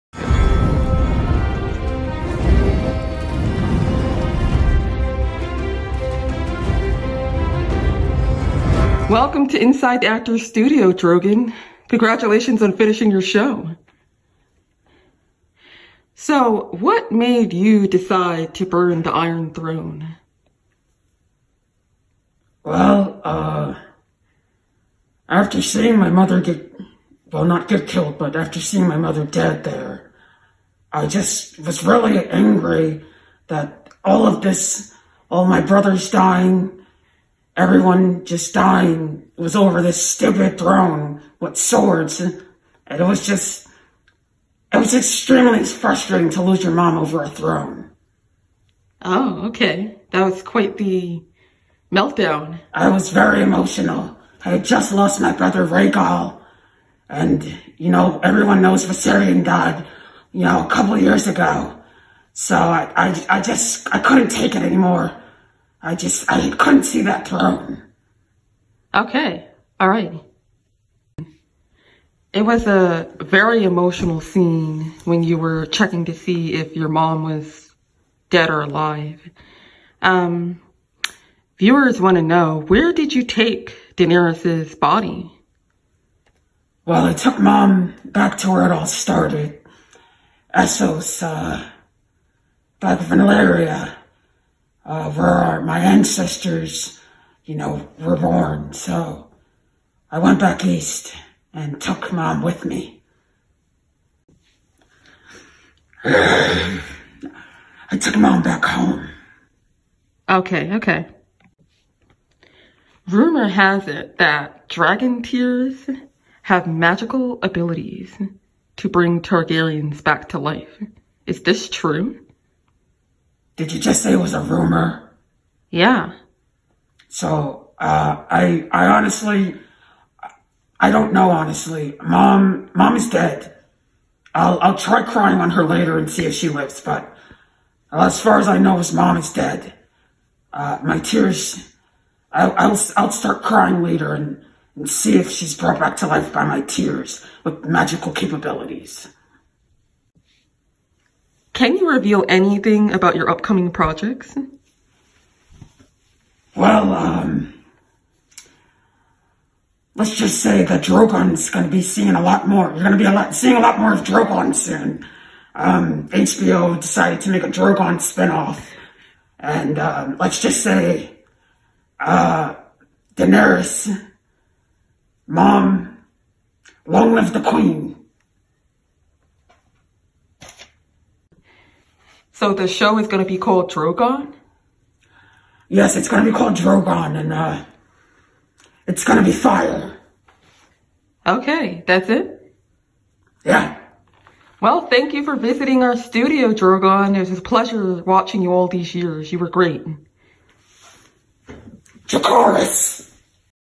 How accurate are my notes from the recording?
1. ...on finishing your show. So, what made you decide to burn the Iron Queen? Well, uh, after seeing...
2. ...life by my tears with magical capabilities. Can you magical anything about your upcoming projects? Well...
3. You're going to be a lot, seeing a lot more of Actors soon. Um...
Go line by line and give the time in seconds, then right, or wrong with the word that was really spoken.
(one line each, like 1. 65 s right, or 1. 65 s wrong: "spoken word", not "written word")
1. 12 s wrong: "Throne", not "Queen"
2. 146 s wrong: "reveal", not "magical"
3. 162 s wrong: "Drogon", not "Actors".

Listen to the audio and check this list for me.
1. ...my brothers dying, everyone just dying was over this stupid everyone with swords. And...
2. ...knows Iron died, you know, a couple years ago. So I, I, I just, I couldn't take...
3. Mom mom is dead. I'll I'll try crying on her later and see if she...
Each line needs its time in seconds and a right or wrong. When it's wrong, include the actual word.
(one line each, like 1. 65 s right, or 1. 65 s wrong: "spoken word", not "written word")
1. 35 s wrong: "throne", not "everyone"
2. 58 s wrong: "Viserion", not "Iron"
3. 132 s right.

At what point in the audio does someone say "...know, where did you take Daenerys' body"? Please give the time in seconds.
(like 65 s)
82 s.